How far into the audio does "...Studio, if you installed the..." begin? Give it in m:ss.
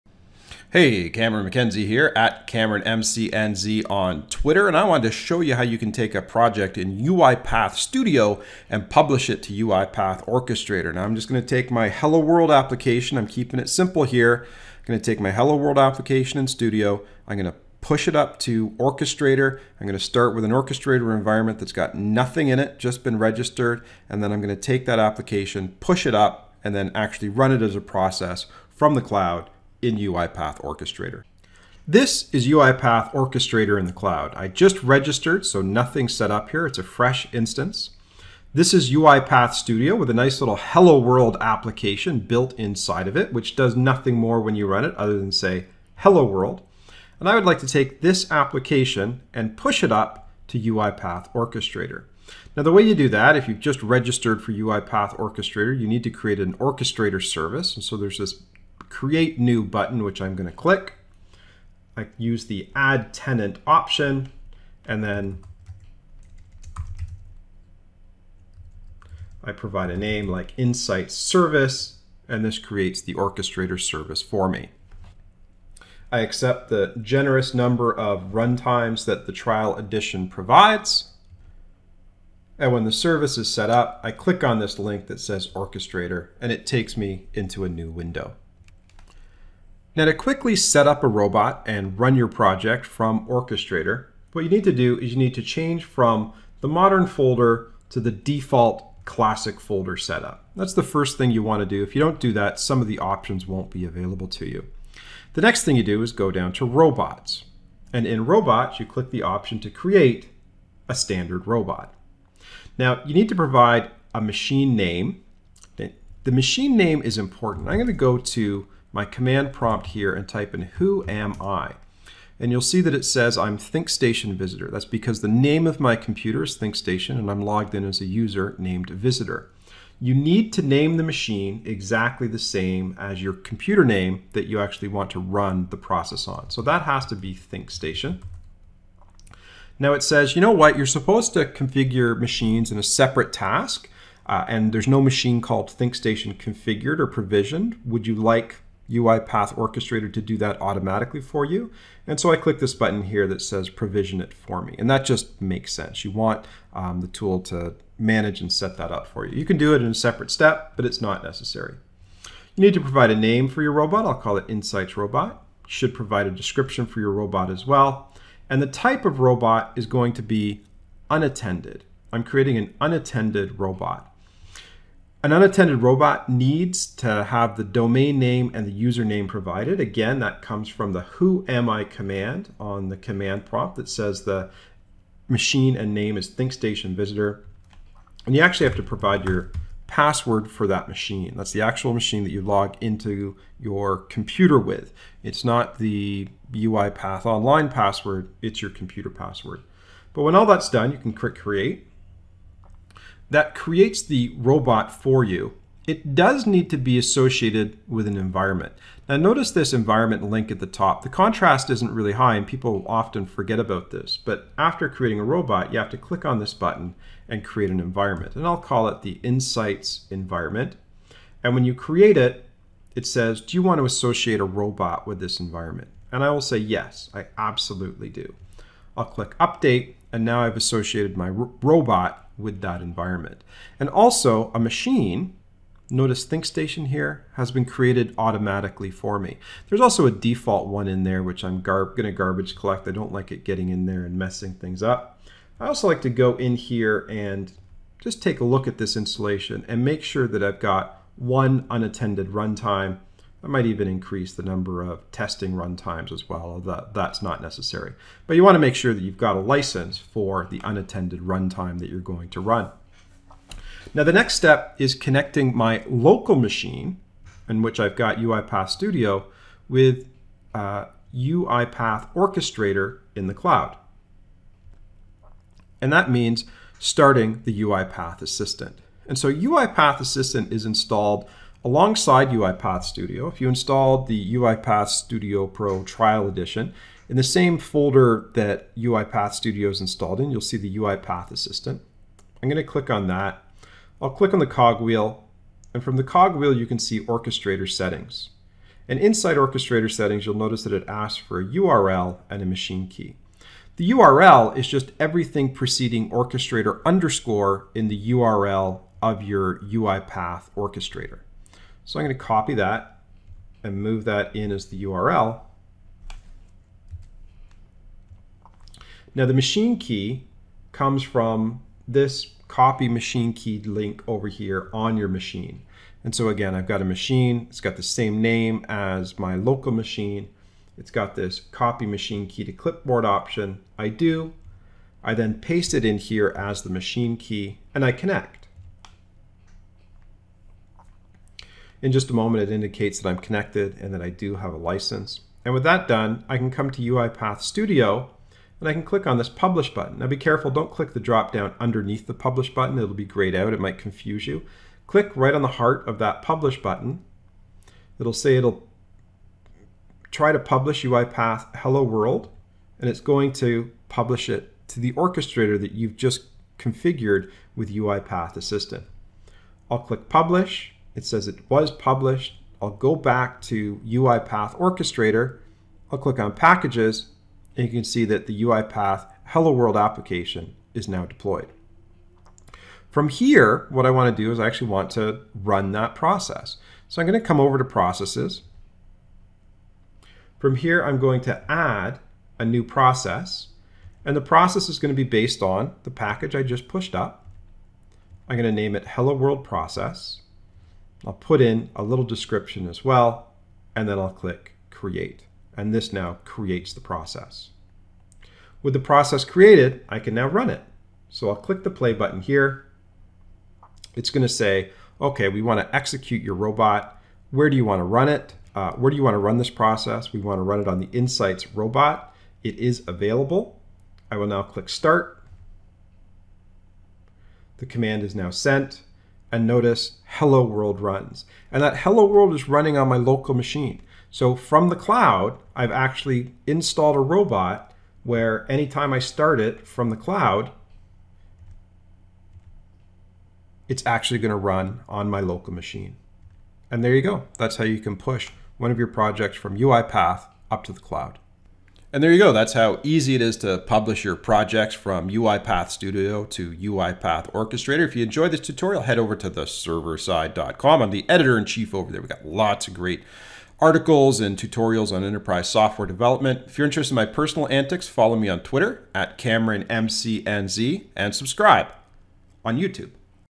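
4:42.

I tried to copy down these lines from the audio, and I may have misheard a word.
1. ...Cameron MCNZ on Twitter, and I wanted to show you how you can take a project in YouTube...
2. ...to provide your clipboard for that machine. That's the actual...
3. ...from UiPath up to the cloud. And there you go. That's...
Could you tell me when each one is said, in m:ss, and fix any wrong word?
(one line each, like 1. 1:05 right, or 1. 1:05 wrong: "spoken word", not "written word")
1. 0:02 wrong: "UiPath", not "YouTube"
2. 3:08 wrong: "password", not "clipboard"
3. 7:29 right.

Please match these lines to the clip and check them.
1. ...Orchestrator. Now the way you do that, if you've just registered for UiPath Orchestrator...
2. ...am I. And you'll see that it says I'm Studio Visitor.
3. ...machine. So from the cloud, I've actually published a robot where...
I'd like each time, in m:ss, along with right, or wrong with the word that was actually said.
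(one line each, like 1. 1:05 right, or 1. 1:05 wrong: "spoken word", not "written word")
1. 0:51 right
2. 2:01 wrong: "ThinkStation", not "Studio"
3. 7:13 wrong: "installed", not "published".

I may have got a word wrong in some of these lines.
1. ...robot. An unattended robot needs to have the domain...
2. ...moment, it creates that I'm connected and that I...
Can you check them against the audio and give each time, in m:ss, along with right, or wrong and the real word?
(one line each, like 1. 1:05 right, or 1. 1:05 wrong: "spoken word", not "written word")
1. 2:53 right
2. 5:42 wrong: "indicates", not "creates".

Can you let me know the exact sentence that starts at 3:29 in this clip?
Now notice this environment link at the top.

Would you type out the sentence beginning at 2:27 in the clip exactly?
Would you like UiPath Orchestrator to do that automatically for you.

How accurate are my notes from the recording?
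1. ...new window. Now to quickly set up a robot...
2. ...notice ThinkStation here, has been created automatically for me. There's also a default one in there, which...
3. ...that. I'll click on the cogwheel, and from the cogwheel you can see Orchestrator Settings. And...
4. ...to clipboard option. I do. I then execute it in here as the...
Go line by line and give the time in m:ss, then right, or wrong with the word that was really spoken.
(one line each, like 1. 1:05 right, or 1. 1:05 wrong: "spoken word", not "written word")
1. 1:27 right
2. 3:55 right
3. 4:53 right
4. 5:32 wrong: "paste", not "execute".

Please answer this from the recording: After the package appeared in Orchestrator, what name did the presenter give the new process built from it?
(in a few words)
Hello World Process.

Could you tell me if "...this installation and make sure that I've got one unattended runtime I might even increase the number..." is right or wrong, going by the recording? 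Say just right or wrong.
right.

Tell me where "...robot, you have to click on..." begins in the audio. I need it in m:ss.
3:35.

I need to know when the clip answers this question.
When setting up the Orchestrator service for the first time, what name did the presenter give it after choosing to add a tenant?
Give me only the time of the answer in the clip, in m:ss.
1:10.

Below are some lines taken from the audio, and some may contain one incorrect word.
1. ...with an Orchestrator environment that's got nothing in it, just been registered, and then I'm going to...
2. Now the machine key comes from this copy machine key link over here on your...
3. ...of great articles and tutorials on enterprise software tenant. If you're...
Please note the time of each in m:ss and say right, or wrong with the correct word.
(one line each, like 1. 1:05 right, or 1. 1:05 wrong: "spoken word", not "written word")
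1. 0:20 right
2. 5:19 right
3. 7:42 wrong: "development", not "tenant".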